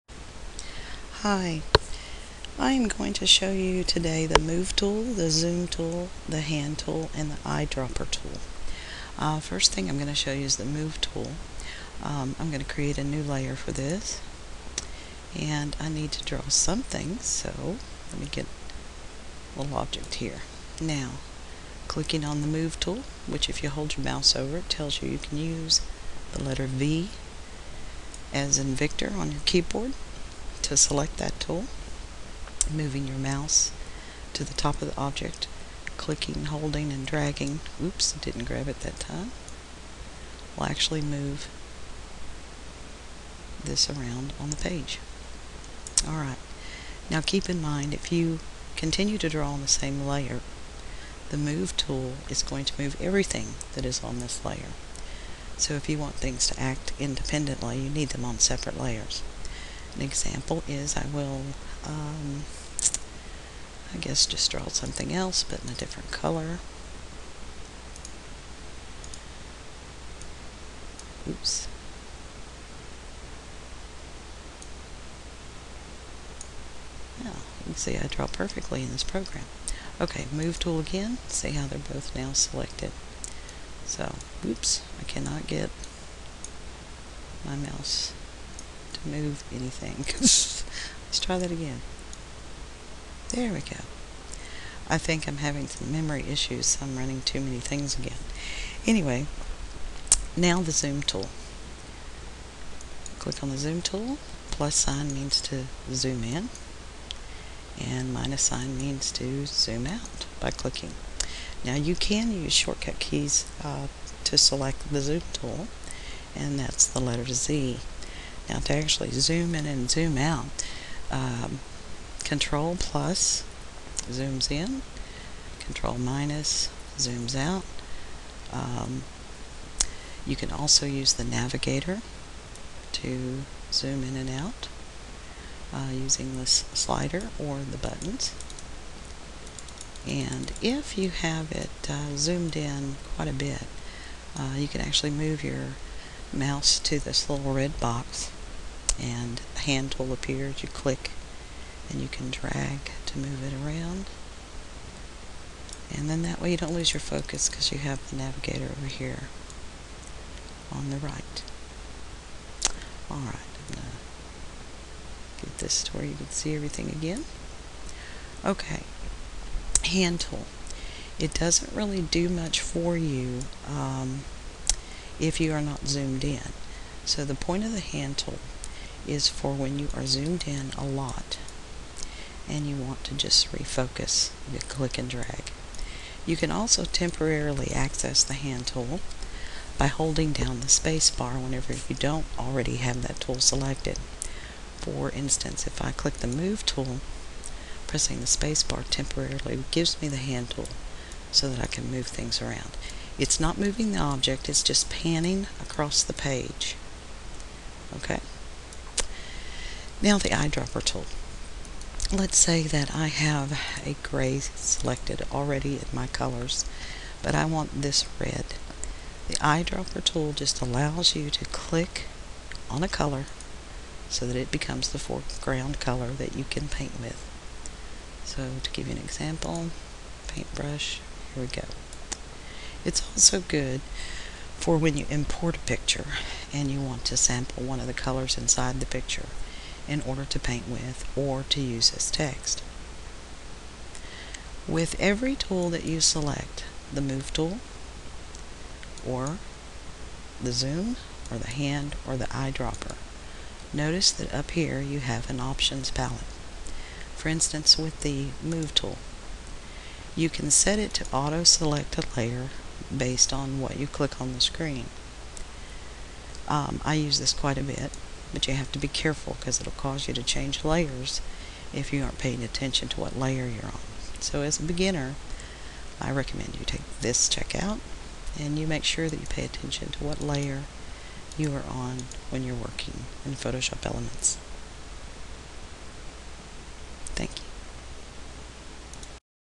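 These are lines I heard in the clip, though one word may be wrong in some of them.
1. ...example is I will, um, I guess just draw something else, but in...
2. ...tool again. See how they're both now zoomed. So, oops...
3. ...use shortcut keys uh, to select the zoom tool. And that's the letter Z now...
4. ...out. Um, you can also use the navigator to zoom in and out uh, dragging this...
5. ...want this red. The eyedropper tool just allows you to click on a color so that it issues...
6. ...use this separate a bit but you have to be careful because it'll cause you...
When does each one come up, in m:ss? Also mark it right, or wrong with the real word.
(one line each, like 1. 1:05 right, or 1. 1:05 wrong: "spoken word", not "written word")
1. 1:00 right
2. 1:20 wrong: "selected", not "zoomed"
3. 1:52 right
4. 2:07 wrong: "using", not "dragging"
5. 3:37 wrong: "becomes", not "issues"
6. 4:26 wrong: "quite", not "separate".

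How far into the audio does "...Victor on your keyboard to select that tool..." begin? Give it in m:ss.
0:28.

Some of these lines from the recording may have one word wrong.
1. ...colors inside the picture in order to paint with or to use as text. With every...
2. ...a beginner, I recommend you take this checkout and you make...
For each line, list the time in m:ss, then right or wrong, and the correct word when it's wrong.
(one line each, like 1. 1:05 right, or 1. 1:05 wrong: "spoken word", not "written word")
1. 3:57 right
2. 4:34 right.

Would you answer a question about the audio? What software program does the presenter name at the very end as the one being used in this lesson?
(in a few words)
Photoshop Elements.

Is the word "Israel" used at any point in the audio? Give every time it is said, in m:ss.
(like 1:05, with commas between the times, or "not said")
not said.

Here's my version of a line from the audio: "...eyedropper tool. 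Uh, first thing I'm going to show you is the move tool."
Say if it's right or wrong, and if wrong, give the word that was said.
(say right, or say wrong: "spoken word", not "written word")
right.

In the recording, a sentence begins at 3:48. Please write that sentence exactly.
So to give you an example, paintbrush, here we go.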